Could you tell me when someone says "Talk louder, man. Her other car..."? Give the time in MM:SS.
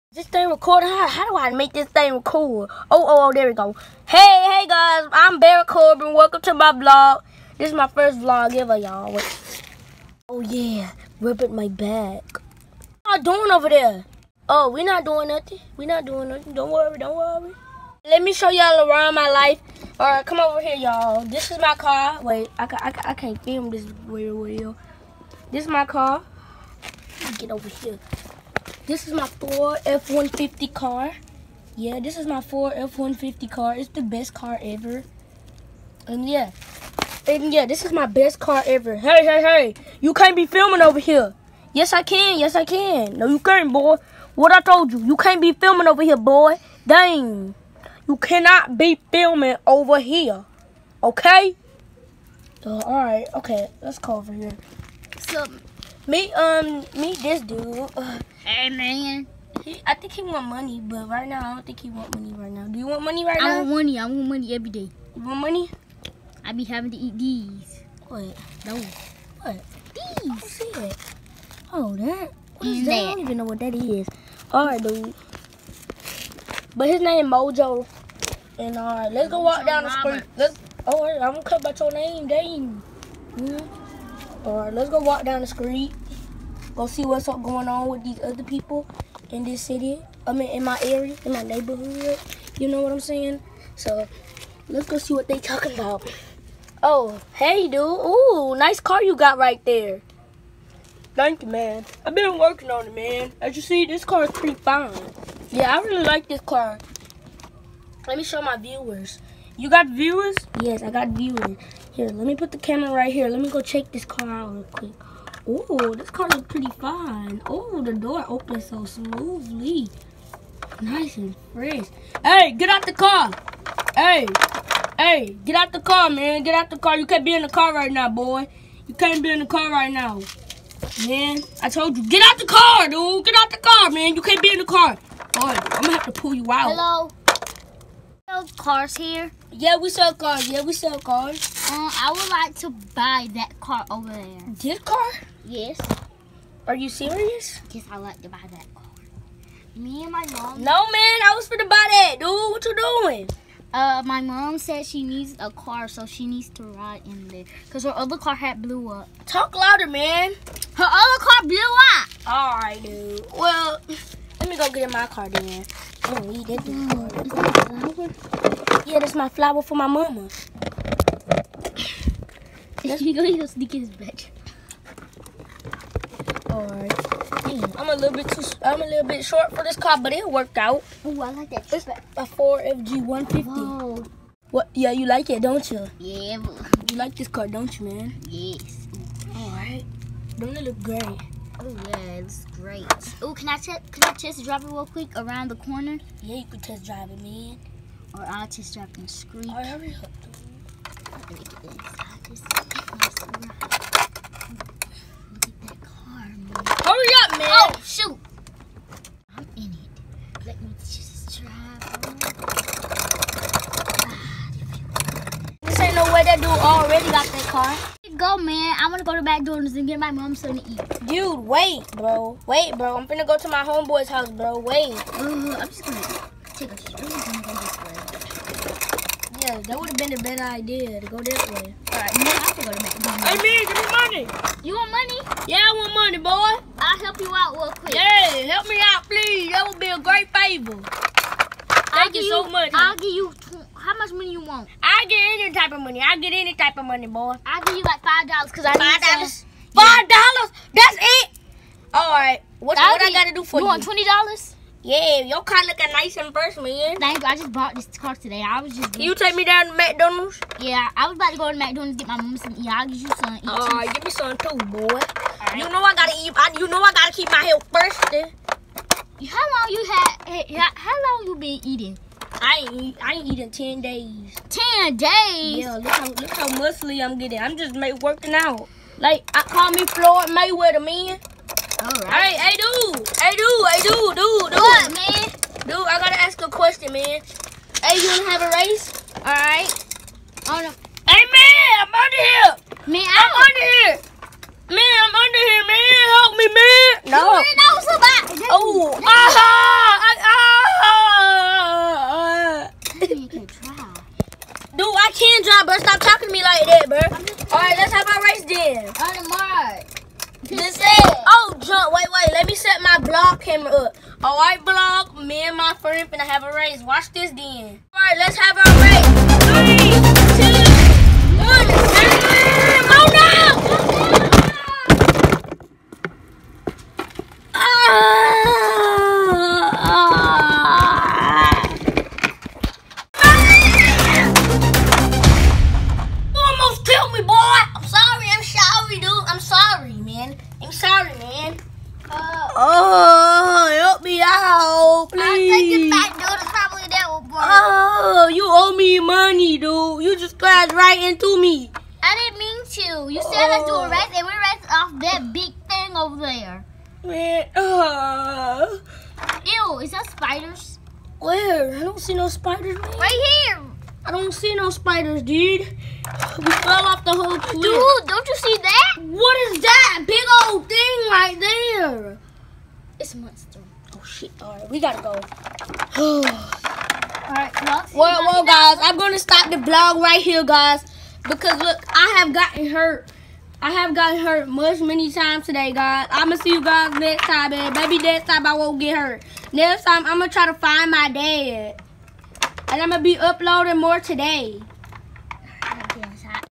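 02:39.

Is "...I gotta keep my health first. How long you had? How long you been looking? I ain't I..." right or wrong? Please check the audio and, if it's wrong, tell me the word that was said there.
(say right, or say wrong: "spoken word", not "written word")
wrong: "eating", not "looking".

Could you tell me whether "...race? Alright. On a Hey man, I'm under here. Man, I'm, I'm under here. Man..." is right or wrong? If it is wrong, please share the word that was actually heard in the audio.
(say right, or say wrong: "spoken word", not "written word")
right.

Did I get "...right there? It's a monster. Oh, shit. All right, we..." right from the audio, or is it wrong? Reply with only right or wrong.
right.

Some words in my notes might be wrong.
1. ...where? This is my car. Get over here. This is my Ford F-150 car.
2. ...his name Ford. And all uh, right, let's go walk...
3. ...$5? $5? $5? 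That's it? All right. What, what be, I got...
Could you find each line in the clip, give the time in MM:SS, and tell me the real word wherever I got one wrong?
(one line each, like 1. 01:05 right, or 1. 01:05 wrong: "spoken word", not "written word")
1. 00:24 right
2. 01:16 wrong: "Mojo", not "Ford"
3. 04:08 right.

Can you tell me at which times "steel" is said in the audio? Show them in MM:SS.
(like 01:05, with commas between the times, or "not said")
not said.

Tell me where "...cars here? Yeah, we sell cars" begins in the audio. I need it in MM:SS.
02:18.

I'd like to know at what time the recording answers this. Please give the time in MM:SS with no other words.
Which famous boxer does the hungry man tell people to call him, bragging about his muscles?
04:39.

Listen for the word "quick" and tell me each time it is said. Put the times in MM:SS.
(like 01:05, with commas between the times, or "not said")
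01:54, 03:14, 03:57.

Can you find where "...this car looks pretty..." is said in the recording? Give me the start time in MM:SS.
01:55.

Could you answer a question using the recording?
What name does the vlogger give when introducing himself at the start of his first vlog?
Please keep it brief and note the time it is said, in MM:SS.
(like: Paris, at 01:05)
Baron Corbin, at 00:05.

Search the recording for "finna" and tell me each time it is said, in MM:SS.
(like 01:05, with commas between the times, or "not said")
03:43, 05:16.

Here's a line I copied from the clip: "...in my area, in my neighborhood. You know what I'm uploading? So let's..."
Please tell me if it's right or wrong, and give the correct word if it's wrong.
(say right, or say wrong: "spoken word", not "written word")
wrong: "saying", not "uploading".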